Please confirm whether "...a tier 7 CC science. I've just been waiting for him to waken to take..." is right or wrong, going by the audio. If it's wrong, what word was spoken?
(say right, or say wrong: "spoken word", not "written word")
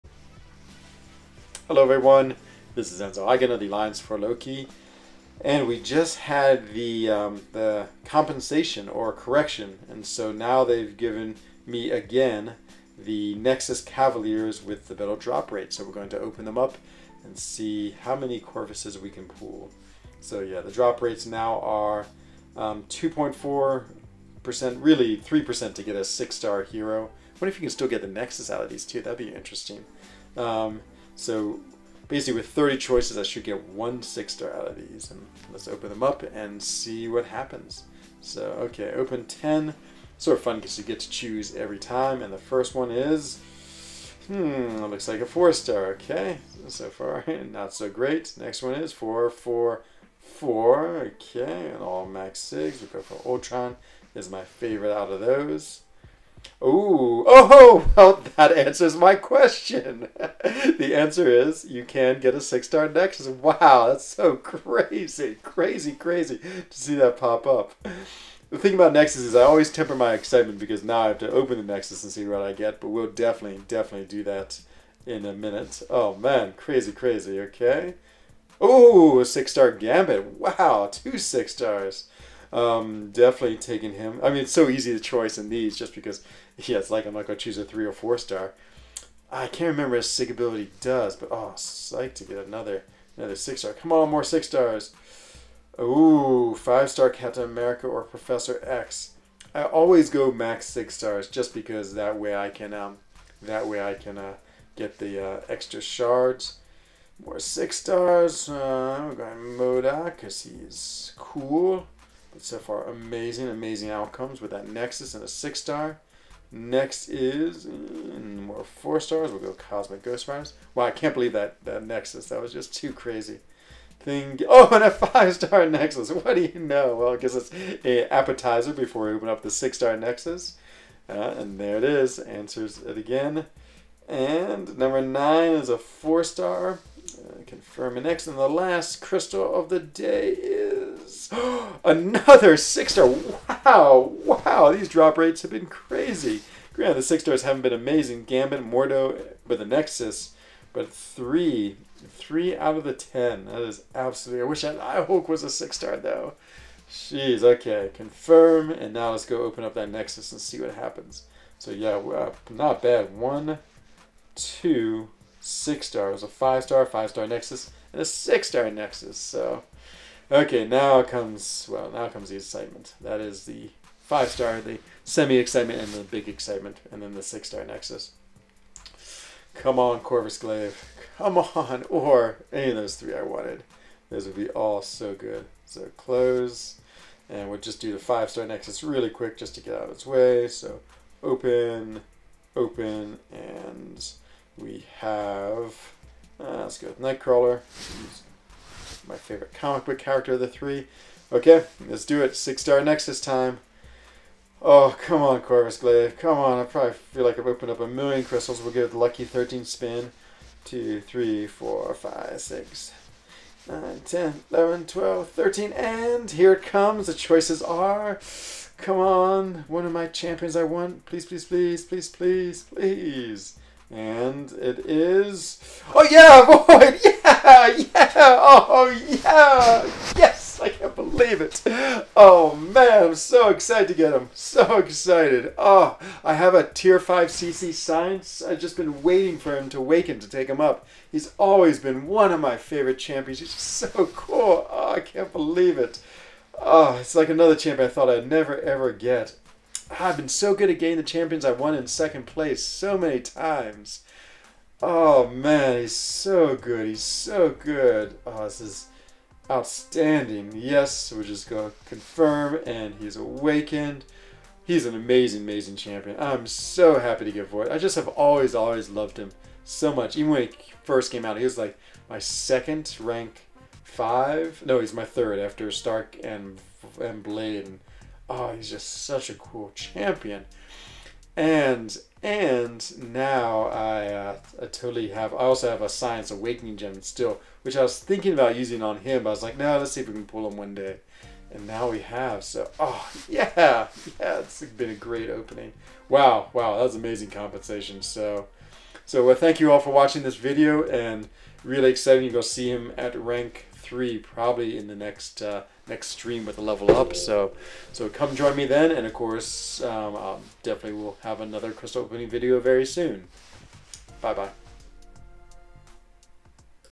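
wrong: "5", not "7".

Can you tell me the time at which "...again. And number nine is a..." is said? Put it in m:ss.
2:12.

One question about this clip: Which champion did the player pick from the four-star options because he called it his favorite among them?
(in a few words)
Ultron.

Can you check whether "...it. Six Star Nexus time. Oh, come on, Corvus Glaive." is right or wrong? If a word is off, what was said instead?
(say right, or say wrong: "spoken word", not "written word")
right.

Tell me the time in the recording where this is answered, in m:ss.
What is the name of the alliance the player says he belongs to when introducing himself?
0:03.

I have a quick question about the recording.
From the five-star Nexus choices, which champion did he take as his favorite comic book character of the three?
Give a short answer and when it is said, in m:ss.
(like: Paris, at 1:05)
Nightcrawler, at 3:17.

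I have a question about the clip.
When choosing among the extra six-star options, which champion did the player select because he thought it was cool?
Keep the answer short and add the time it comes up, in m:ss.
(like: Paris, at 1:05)
MODOK, at 1:49.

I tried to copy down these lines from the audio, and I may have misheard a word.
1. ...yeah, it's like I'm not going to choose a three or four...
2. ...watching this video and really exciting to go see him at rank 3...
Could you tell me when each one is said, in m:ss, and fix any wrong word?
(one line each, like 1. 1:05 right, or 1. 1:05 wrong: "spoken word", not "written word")
1. 1:26 right
2. 4:59 right.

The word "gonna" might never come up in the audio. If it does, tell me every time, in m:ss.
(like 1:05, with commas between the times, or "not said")
4:21.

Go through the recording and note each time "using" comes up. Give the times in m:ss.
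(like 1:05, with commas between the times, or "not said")
4:48.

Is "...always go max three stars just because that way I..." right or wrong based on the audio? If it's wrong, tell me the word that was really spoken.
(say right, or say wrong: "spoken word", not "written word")
wrong: "six", not "three".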